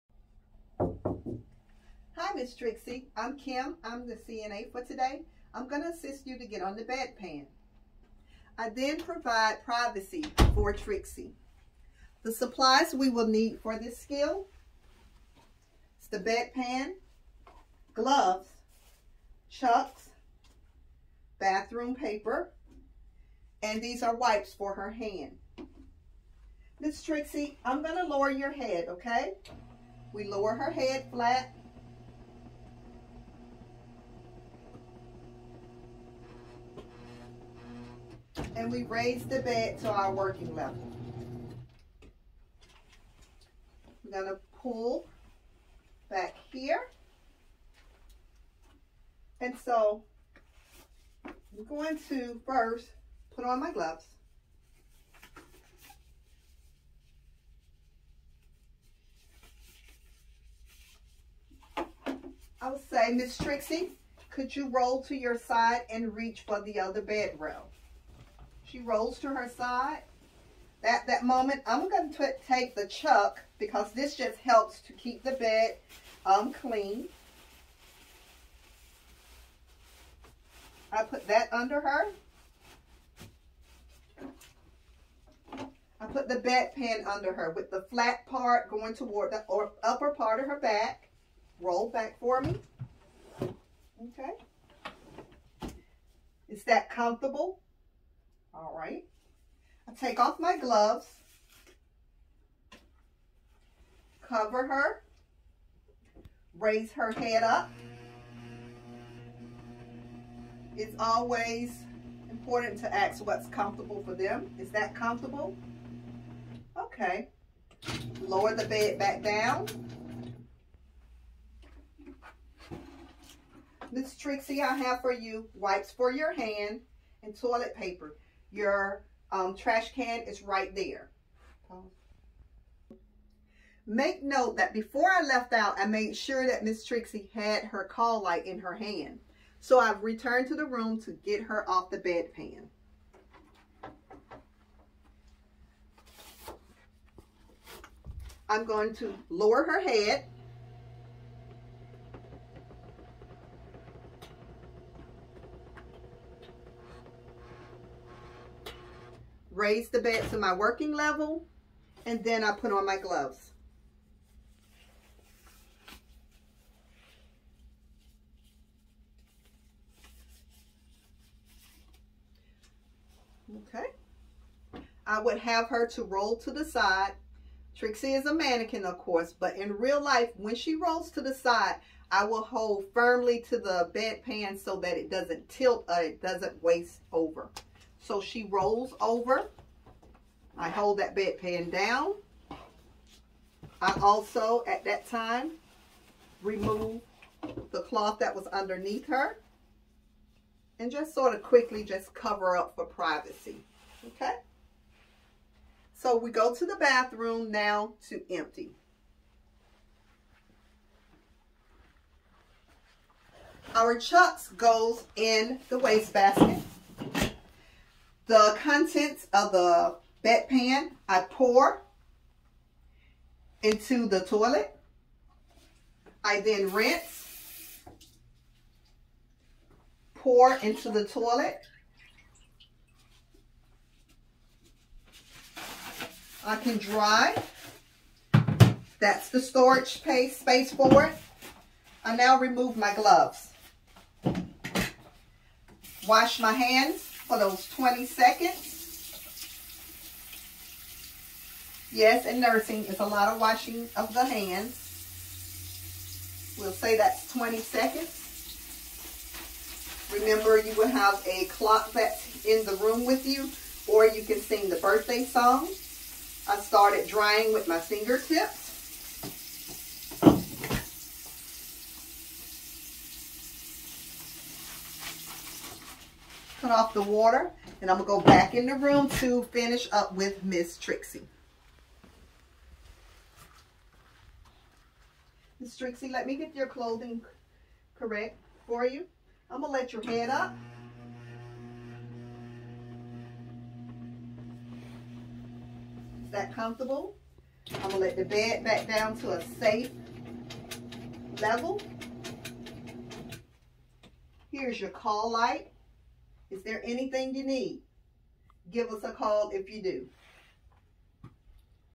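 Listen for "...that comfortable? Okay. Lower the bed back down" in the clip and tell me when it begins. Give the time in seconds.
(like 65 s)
114 s.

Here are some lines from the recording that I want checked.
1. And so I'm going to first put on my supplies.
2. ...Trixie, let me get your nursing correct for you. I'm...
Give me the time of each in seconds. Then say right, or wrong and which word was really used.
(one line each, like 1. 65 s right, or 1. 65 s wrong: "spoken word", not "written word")
1. 49 s wrong: "gloves", not "supplies"
2. 285 s wrong: "clothing", not "nursing".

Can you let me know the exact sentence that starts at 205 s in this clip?
So we go to the bathroom now to empty.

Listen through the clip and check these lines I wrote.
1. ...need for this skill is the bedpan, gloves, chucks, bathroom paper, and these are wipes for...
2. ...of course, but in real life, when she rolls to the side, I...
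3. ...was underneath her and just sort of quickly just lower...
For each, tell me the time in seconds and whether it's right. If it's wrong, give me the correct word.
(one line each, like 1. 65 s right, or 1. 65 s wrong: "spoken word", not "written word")
1. 13 s right
2. 178 s right
3. 198 s wrong: "cover", not "lower".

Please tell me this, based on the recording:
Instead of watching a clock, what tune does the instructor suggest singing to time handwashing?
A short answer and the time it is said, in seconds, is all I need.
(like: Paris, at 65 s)
the birthday song, at 264 s.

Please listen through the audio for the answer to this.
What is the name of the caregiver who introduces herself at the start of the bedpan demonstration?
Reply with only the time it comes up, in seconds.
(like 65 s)
3 s.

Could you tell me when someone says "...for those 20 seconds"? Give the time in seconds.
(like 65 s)
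247 s.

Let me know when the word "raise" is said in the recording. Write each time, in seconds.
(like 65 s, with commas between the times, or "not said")
38 s, 106 s, 159 s.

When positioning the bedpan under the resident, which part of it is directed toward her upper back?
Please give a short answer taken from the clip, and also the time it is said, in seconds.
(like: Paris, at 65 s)
the flat part, at 87 s.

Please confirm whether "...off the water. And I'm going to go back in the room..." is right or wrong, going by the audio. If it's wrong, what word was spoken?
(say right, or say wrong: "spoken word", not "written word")
right.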